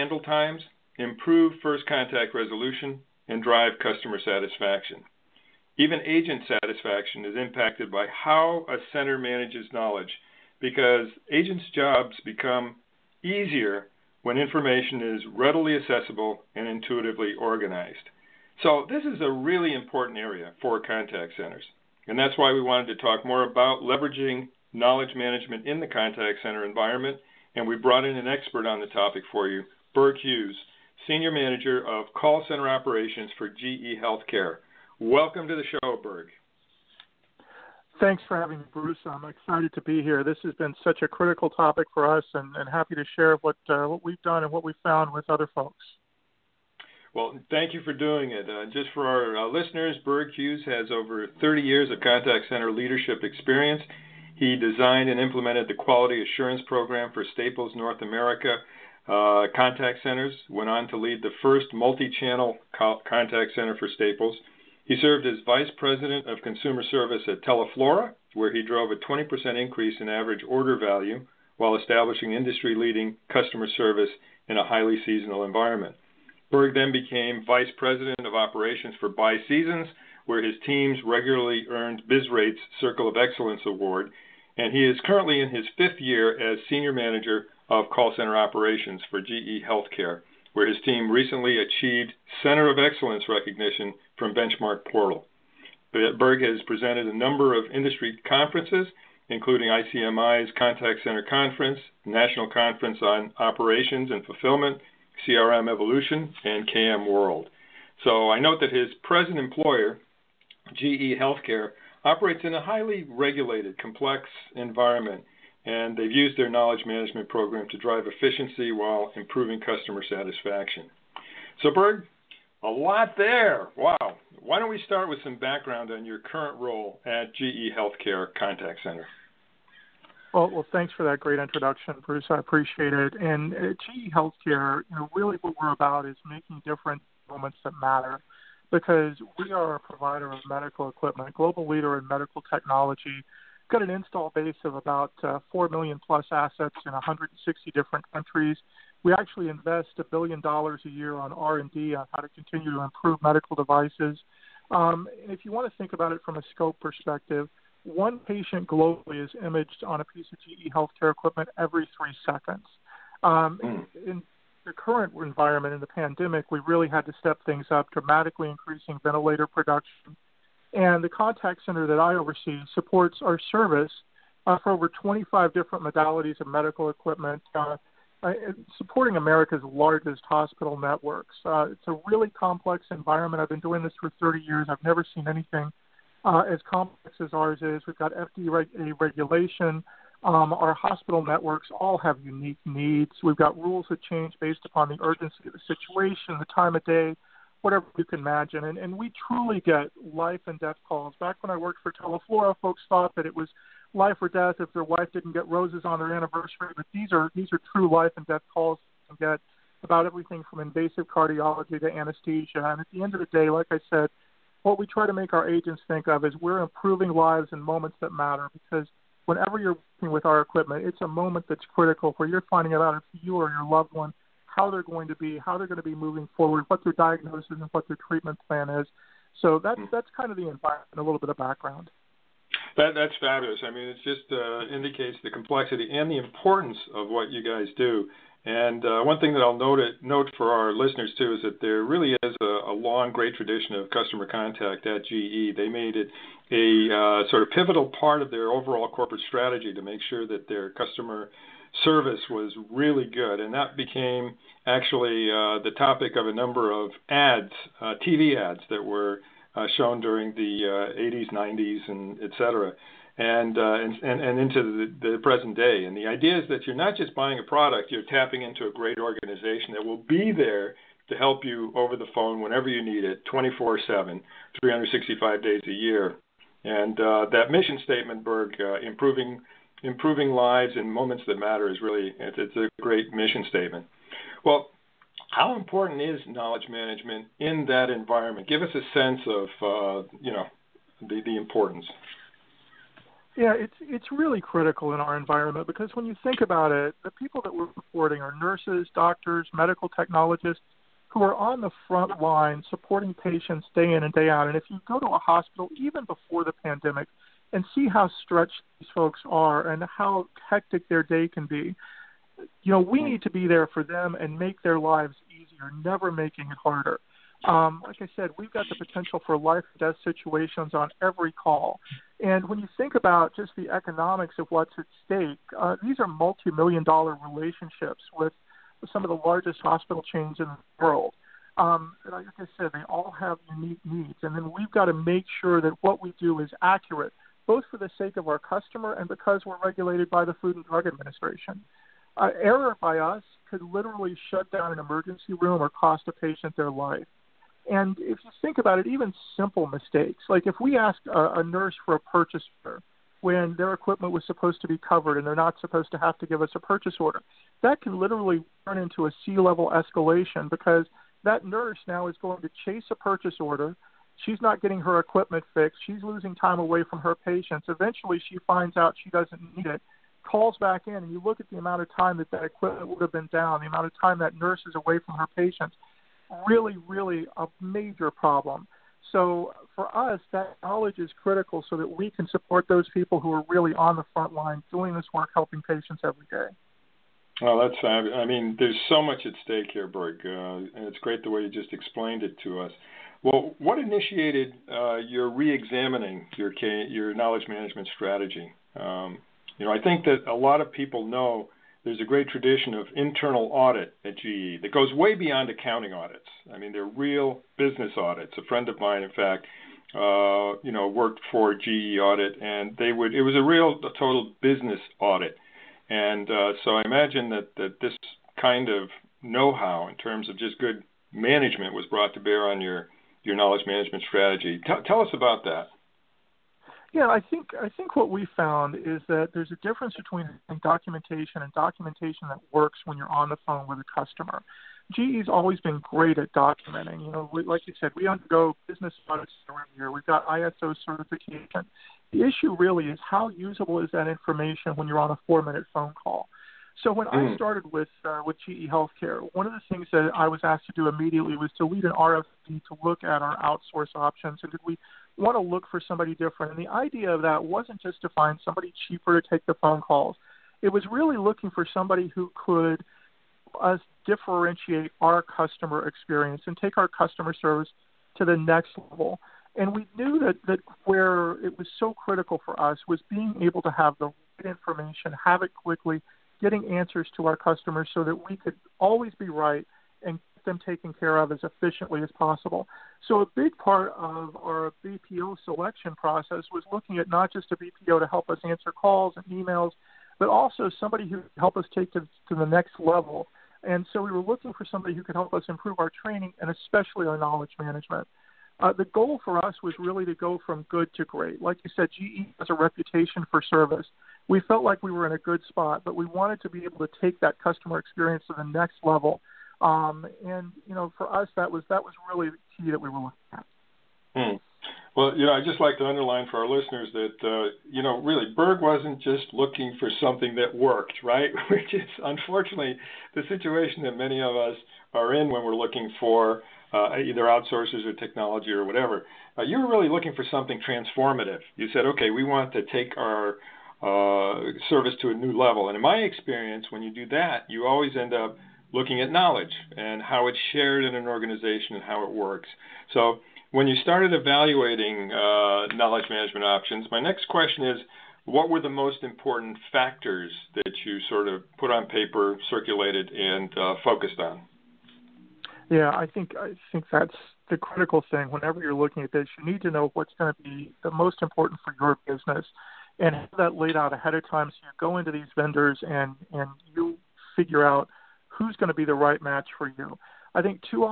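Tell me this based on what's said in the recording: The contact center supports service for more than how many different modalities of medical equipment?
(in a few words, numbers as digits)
25.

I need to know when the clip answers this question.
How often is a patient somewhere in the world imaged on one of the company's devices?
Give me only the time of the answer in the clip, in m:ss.
2:41.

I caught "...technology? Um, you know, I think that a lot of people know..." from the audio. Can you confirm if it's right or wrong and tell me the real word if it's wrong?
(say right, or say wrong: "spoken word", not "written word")
wrong: "strategy", not "technology".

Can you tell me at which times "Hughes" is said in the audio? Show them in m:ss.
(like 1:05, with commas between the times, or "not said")
0:30, 0:50.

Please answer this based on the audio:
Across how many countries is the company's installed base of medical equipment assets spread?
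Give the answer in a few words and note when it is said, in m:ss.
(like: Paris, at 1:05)
160, at 2:26.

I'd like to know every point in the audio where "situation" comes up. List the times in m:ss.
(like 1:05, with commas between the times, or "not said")
3:15, 5:20, 8:43.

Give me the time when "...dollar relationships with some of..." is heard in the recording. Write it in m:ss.
5:26.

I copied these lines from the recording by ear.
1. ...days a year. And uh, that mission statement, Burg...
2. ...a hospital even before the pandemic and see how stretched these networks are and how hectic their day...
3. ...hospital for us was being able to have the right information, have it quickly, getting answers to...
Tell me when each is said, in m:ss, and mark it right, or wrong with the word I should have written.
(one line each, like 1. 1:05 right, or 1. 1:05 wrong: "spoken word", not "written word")
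1. 4:35 right
2. 5:05 wrong: "folks", not "networks"
3. 7:51 wrong: "critical", not "hospital".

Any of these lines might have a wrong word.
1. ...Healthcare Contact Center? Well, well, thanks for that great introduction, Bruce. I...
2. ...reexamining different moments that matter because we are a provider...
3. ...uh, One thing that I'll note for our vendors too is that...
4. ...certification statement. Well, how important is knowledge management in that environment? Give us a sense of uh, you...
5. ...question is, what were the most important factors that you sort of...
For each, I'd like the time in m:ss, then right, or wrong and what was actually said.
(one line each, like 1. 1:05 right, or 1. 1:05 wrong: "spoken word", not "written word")
1. 2:07 right
2. 2:16 wrong: "making", not "reexamining"
3. 3:58 wrong: "listeners", not "vendors"
4. 4:43 wrong: "mission", not "certification"
5. 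9:07 right.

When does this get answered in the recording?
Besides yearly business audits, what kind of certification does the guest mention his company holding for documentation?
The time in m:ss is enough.
7:20.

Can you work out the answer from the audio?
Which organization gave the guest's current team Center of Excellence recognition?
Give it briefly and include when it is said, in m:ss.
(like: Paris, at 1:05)
Benchmark Portal, at 1:34.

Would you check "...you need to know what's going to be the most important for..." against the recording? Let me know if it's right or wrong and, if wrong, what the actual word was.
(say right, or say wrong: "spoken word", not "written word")
right.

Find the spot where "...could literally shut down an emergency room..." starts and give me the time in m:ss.
5:43.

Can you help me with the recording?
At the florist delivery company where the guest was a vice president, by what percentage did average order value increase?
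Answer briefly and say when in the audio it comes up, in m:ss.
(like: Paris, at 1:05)
20%, at 1:08.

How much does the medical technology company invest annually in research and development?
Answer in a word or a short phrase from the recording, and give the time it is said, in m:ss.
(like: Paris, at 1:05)
a billion dollars, at 2:29.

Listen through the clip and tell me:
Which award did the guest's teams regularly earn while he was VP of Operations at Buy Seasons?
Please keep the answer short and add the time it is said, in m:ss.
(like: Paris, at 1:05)
Circle of Excellence Award, at 1:22.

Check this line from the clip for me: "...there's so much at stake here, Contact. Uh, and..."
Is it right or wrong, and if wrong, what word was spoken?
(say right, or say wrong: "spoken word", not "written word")
wrong: "Burg", not "Contact".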